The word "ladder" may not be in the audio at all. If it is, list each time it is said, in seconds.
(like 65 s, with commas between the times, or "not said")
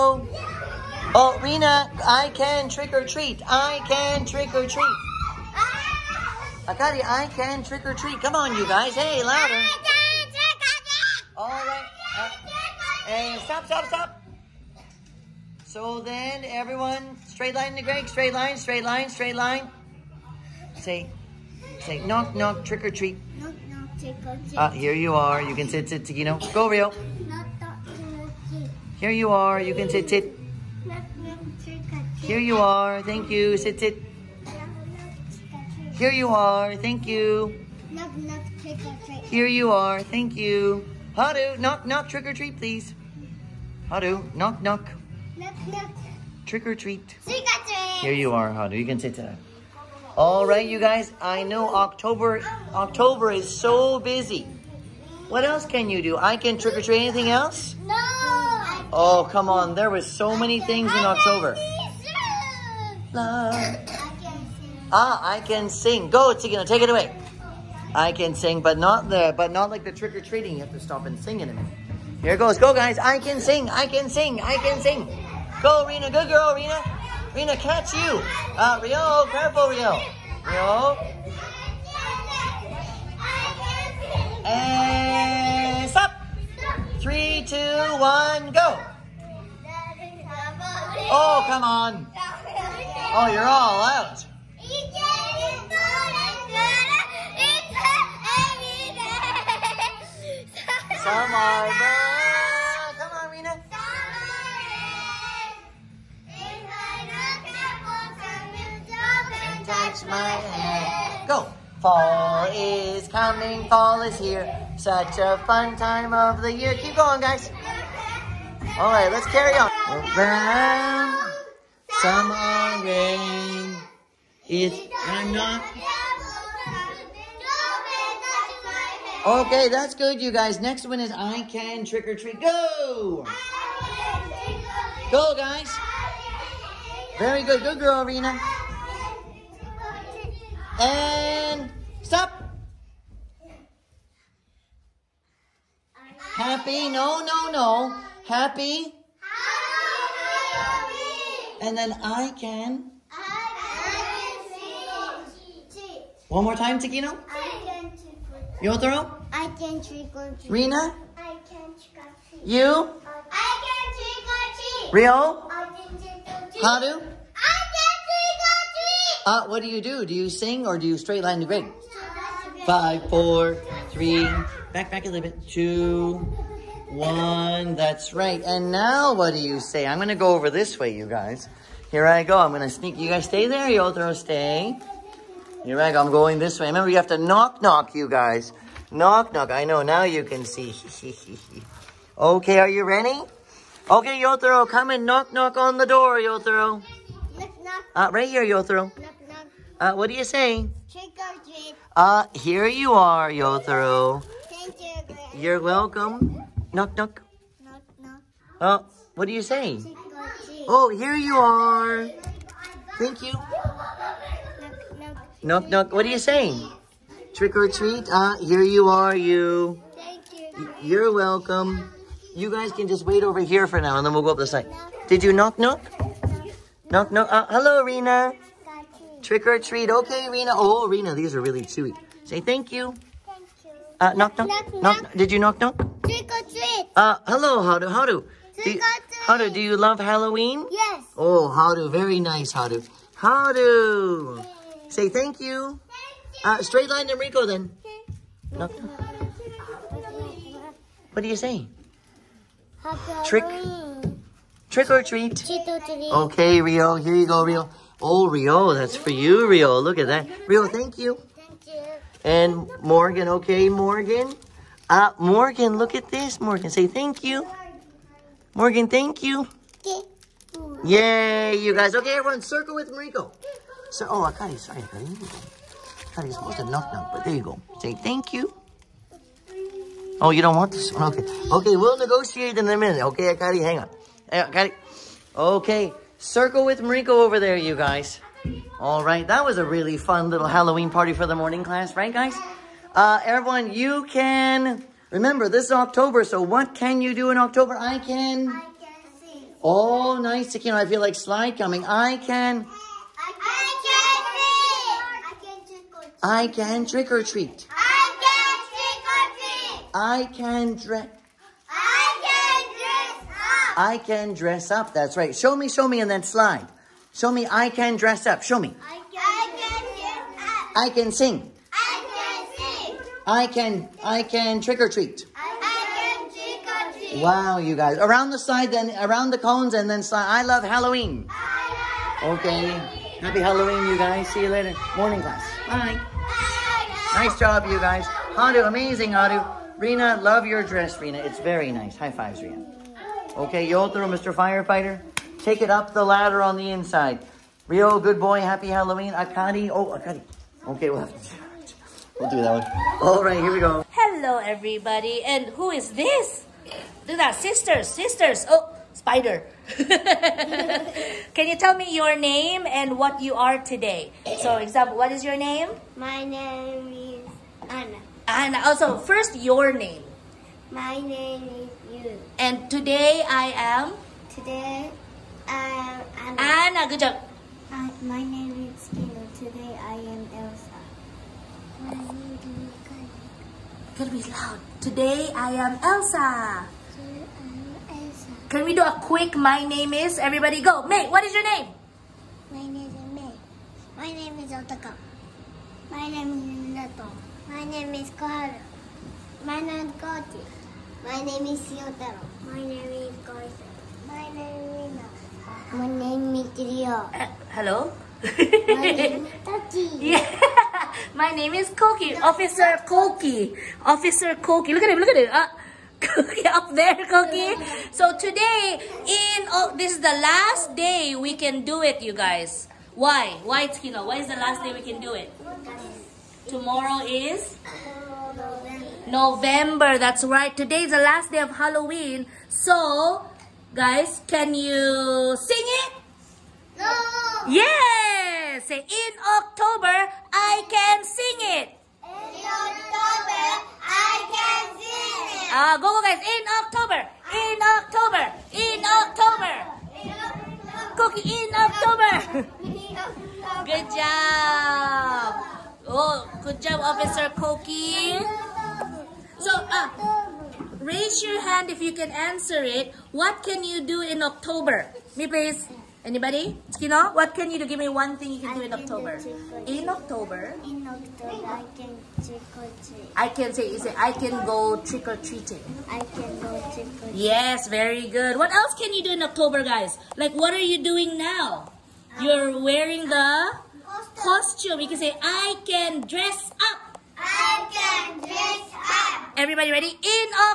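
346 s.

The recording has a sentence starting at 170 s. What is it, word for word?
Do you sing or do you straight line the grade?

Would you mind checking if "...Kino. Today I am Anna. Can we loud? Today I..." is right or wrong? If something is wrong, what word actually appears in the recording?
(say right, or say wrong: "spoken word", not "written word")
wrong: "Elsa", not "Anna".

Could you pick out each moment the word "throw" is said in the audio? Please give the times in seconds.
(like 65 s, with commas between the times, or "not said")
158 s, 183 s, 203 s.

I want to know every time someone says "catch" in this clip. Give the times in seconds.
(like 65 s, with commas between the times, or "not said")
77 s.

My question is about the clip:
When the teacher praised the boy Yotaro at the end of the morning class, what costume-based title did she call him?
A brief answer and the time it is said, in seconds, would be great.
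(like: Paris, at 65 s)
Mr. Firefighter, at 344 s.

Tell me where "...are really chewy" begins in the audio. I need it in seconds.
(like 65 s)
231 s.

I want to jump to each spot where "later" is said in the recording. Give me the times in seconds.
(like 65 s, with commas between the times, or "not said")
334 s.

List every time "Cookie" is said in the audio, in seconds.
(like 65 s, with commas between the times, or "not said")
450 s, 457 s.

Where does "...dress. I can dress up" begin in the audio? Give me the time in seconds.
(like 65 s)
310 s.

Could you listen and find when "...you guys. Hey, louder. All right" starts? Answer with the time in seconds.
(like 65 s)
8 s.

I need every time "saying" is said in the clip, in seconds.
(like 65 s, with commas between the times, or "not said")
209 s, 216 s.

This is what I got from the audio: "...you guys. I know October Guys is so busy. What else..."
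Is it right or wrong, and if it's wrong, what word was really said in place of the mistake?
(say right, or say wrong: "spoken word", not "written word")
wrong: "October", not "Guys".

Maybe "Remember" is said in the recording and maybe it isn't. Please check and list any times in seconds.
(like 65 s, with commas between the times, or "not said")
186 s, 295 s.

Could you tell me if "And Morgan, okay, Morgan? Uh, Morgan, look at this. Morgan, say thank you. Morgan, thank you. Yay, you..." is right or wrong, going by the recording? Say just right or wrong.
right.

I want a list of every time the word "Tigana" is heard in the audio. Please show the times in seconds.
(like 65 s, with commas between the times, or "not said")
66 s.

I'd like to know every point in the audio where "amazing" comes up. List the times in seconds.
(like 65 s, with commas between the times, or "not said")
338 s.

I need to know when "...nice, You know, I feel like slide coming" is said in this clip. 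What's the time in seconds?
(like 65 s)
300 s.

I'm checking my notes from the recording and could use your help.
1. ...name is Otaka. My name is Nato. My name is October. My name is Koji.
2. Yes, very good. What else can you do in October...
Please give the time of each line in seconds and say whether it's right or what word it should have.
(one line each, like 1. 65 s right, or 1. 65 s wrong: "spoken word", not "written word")
1. 394 s wrong: "Koharu", not "October"
2. 477 s right.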